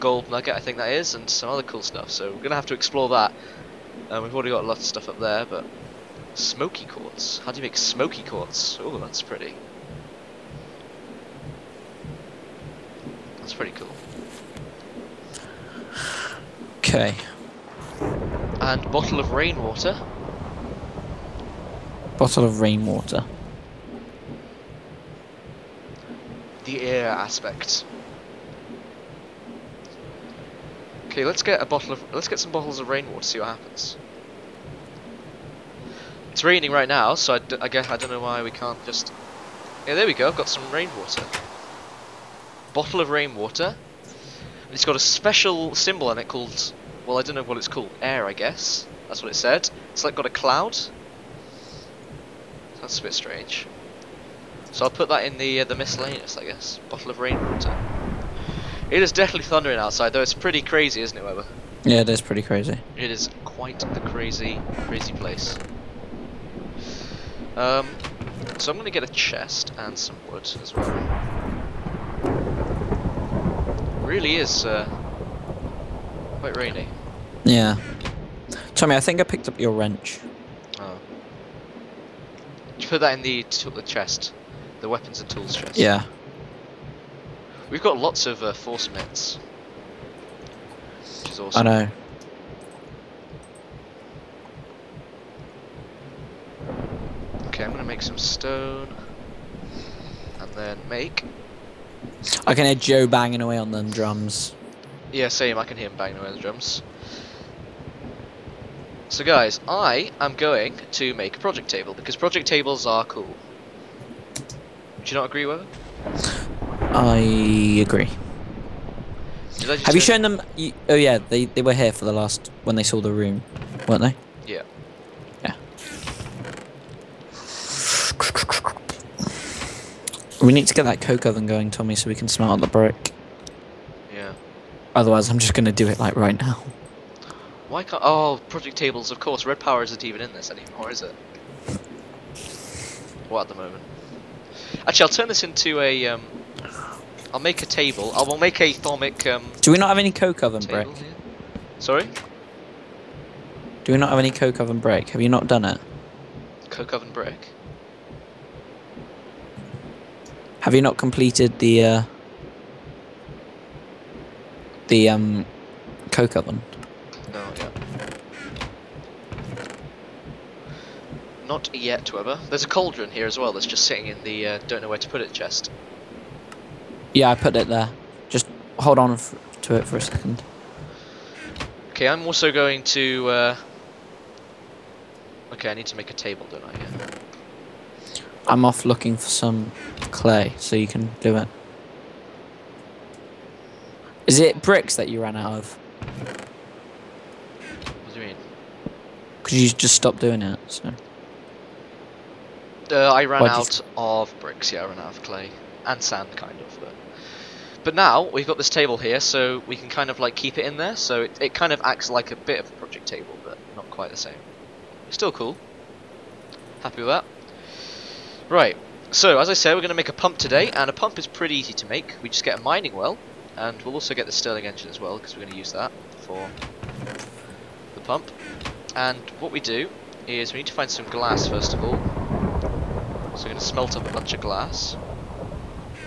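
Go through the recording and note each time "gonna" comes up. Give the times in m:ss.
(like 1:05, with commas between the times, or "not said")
0:02, 1:37.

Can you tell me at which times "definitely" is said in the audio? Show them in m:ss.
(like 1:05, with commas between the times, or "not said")
0:59.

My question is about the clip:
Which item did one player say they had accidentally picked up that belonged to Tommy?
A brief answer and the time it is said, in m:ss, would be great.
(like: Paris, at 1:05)
Wrench, at 1:19.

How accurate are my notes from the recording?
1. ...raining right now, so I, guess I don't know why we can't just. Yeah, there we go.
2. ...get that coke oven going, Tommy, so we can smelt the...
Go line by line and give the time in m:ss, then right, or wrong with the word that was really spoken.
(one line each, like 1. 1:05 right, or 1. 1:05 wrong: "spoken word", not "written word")
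1. 0:36 right
2. 2:10 right.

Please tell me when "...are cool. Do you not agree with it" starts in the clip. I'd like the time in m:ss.
1:52.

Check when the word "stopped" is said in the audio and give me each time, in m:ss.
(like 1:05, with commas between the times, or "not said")
3:19.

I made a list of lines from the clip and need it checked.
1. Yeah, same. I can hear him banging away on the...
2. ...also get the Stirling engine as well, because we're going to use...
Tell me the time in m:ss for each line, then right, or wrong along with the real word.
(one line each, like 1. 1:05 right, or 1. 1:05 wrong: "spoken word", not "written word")
1. 1:45 right
2. 3:43 right.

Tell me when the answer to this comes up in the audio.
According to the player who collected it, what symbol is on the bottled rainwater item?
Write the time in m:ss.
0:50.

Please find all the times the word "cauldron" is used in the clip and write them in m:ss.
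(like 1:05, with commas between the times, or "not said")
2:52.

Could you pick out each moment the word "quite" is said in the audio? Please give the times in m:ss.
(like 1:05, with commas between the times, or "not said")
1:03, 1:16, 3:33.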